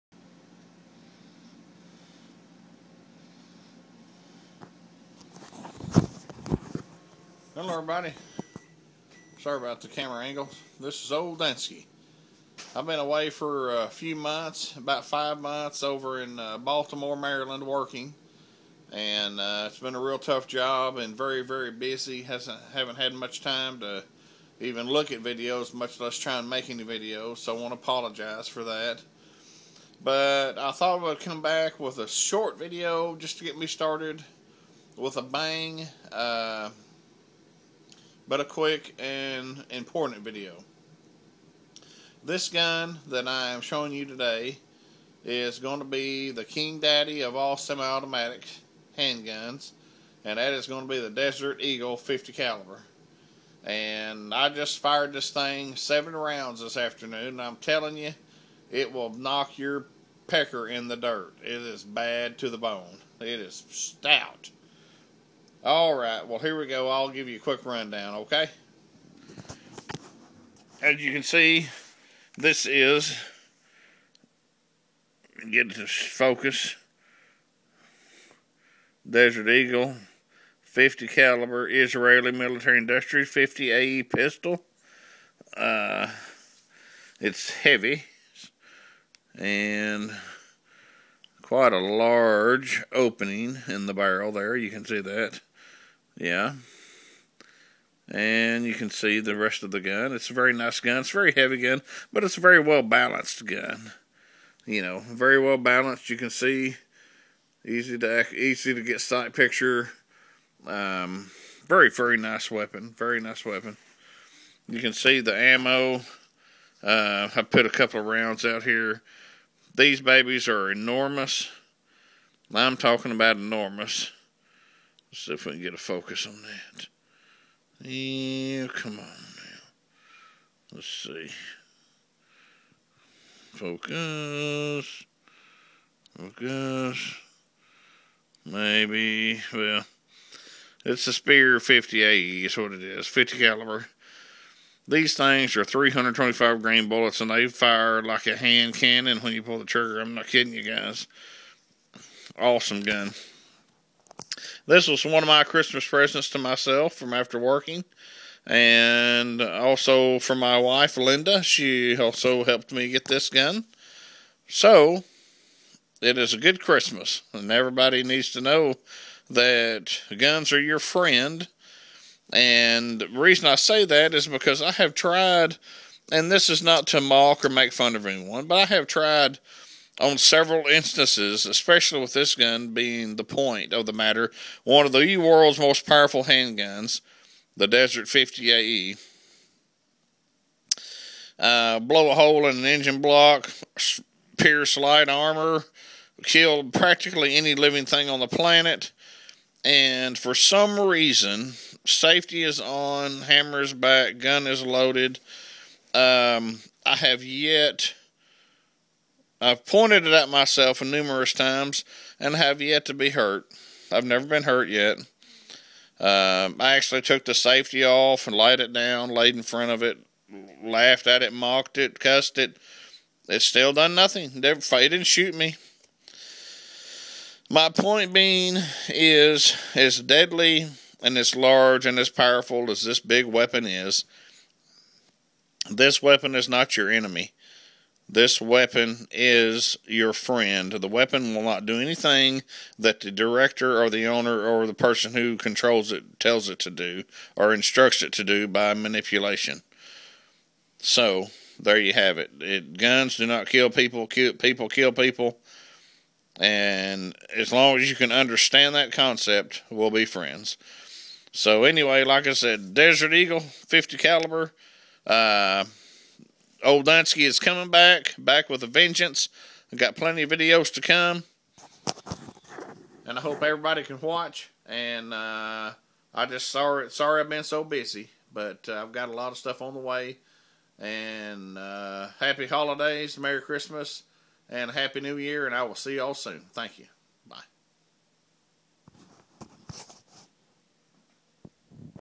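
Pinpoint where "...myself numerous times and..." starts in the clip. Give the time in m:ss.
3:30.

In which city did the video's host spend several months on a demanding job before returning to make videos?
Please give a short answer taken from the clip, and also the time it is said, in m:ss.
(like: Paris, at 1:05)
Baltimore, at 0:16.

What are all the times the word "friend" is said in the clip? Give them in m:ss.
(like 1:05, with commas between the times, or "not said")
2:50, 4:00, 4:20.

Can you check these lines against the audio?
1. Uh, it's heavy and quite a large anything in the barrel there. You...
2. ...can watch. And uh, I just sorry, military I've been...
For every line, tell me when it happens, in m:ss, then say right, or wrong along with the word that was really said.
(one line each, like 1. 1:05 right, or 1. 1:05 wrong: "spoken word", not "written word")
1. 1:25 wrong: "opening", not "anything"
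2. 4:33 wrong: "sorry", not "military".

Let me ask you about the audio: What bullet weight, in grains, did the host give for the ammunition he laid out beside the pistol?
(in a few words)
325 grain.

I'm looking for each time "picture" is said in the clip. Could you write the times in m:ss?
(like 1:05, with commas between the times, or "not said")
1:49.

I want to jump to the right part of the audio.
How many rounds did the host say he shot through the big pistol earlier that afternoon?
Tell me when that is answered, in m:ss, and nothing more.
0:55.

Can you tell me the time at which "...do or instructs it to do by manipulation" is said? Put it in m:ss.
4:06.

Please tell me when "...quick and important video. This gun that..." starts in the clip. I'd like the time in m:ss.
0:38.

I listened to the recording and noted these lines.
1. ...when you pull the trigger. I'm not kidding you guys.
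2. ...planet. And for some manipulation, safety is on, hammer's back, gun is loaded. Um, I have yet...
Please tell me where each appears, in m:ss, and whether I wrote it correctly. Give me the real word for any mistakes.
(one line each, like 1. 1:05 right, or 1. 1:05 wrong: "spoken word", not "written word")
1. 2:29 right
2. 3:18 wrong: "reason", not "manipulation".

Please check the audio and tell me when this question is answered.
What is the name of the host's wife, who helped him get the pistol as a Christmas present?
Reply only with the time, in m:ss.
2:40.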